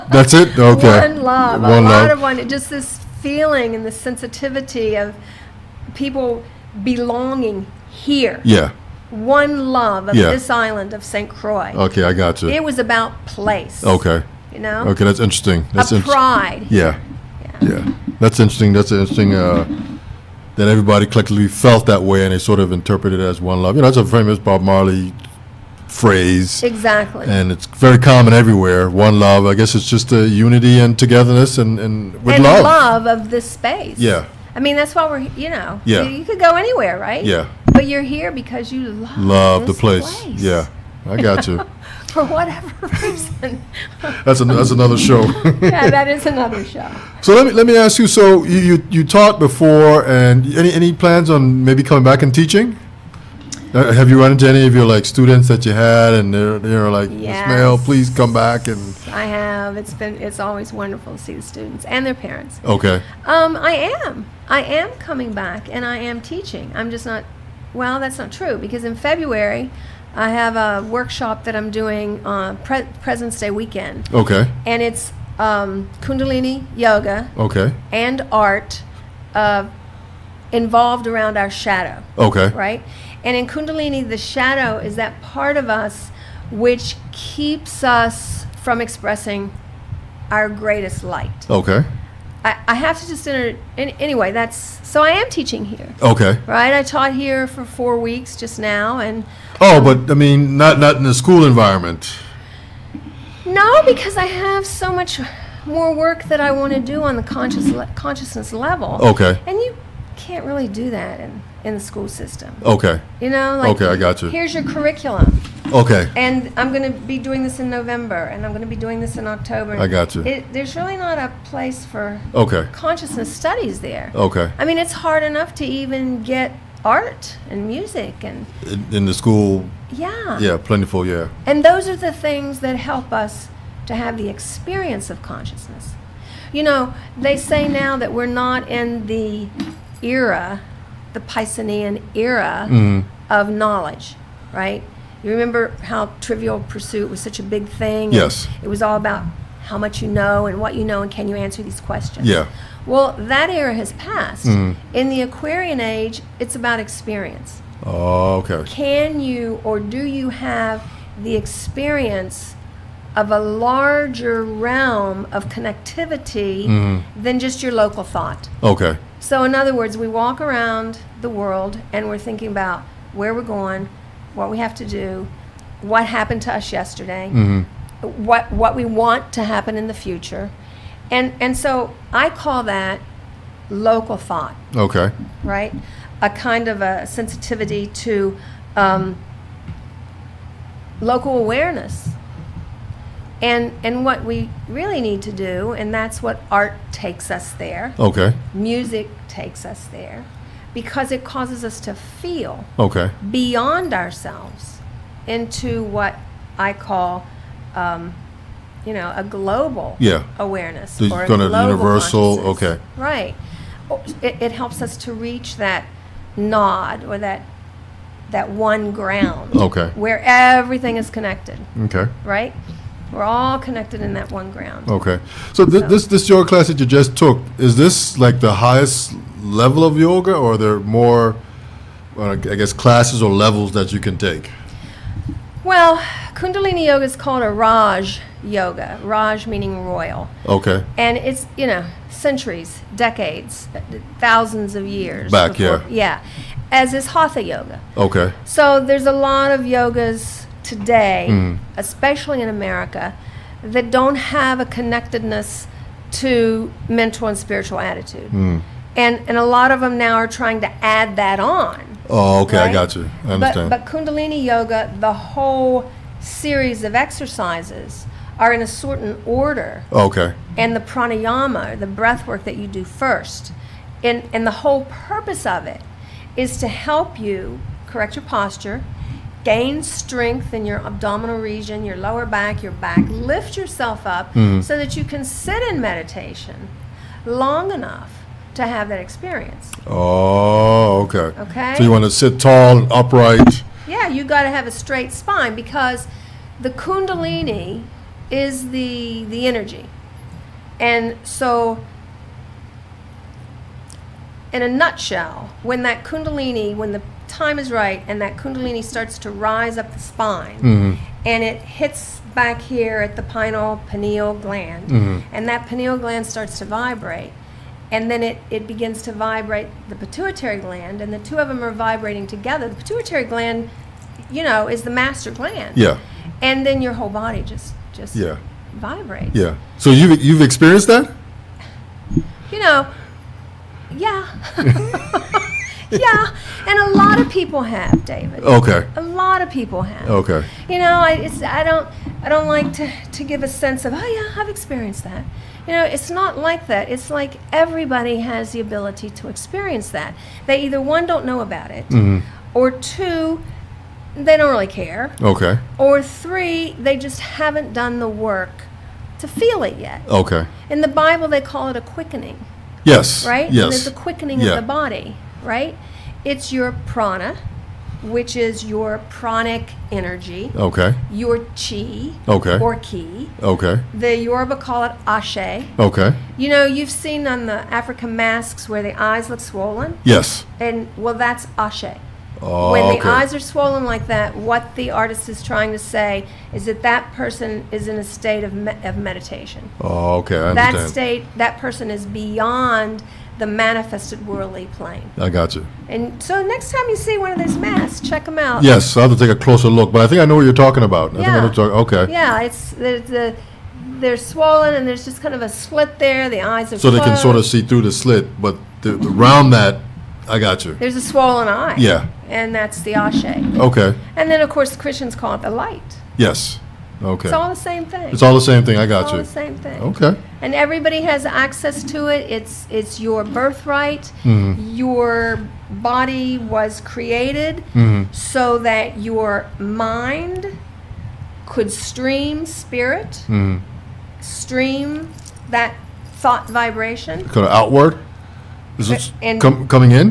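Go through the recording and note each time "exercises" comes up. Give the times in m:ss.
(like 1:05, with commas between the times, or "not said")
4:26.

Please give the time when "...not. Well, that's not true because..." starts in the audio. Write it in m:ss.
1:07.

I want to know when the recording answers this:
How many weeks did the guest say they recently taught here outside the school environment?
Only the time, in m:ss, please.
1:37.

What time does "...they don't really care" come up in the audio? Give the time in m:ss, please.
5:54.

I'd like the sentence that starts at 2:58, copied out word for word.
what what we want to happen in the future, and and so I call that local thought.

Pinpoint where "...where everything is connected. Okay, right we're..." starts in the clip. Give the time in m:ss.
3:39.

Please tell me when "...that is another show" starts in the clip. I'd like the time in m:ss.
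0:45.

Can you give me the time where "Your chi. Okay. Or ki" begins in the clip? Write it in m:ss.
6:11.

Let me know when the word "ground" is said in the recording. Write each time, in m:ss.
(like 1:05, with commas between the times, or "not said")
3:38, 3:44.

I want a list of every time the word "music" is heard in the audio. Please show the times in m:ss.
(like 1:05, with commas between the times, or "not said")
2:07, 3:18.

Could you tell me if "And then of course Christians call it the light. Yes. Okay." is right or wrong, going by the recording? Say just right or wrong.
right.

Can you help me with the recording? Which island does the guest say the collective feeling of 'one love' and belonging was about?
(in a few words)
St. Croix.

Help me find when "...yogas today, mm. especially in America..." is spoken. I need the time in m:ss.
4:09.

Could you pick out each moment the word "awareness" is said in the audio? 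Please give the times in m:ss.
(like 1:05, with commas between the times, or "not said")
3:11, 3:30.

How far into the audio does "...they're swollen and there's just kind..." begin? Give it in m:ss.
6:43.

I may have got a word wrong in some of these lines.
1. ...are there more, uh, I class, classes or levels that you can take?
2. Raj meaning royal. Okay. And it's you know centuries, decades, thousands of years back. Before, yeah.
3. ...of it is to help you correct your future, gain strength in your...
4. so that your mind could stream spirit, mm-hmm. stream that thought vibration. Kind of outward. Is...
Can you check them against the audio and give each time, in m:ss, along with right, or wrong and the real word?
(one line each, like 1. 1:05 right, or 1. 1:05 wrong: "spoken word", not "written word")
1. 3:50 wrong: "guess", not "class"
2. 3:59 right
3. 4:35 wrong: "posture", not "future"
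4. 7:08 right.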